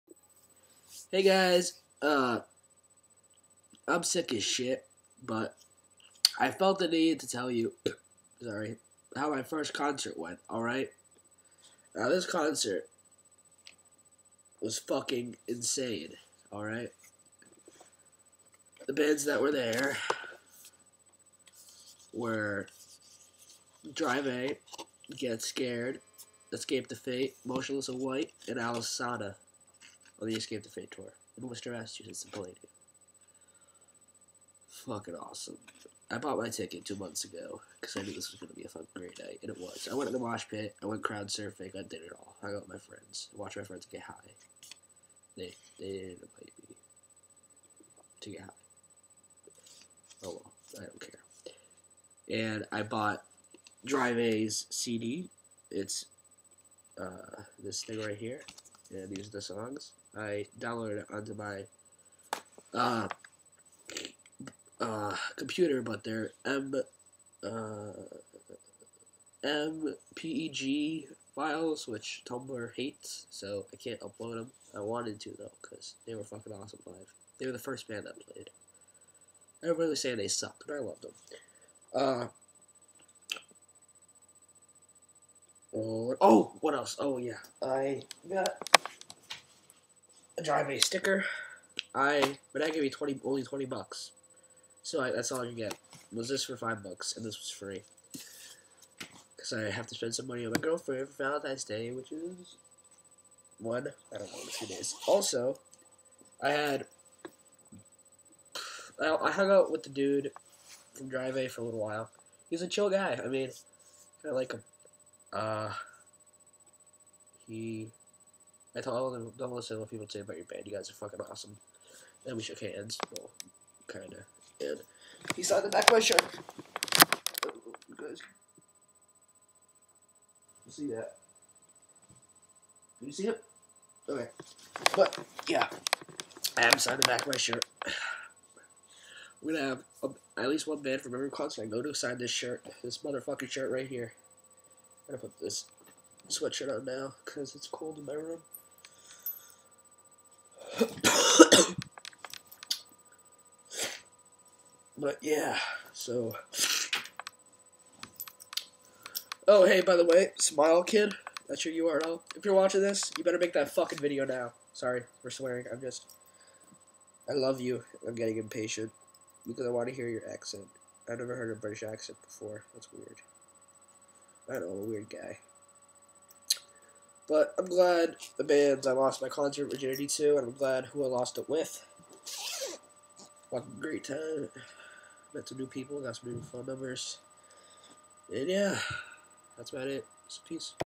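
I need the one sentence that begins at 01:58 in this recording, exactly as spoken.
I told all the them, listen to what people say about your band.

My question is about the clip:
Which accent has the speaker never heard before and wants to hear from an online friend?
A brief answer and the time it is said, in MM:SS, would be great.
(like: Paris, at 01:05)
British, at 02:51.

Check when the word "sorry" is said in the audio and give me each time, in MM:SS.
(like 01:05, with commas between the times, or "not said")
00:08, 02:44.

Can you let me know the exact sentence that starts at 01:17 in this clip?
They were the first band that played.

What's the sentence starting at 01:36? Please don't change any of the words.
Was this for five bucks and this was free.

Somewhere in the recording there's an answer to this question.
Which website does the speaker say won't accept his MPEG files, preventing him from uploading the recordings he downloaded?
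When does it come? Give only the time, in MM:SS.
01:12.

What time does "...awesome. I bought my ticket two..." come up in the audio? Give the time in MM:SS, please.
00:35.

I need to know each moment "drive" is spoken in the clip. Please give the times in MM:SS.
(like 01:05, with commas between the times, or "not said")
00:23, 00:53, 01:30, 01:51.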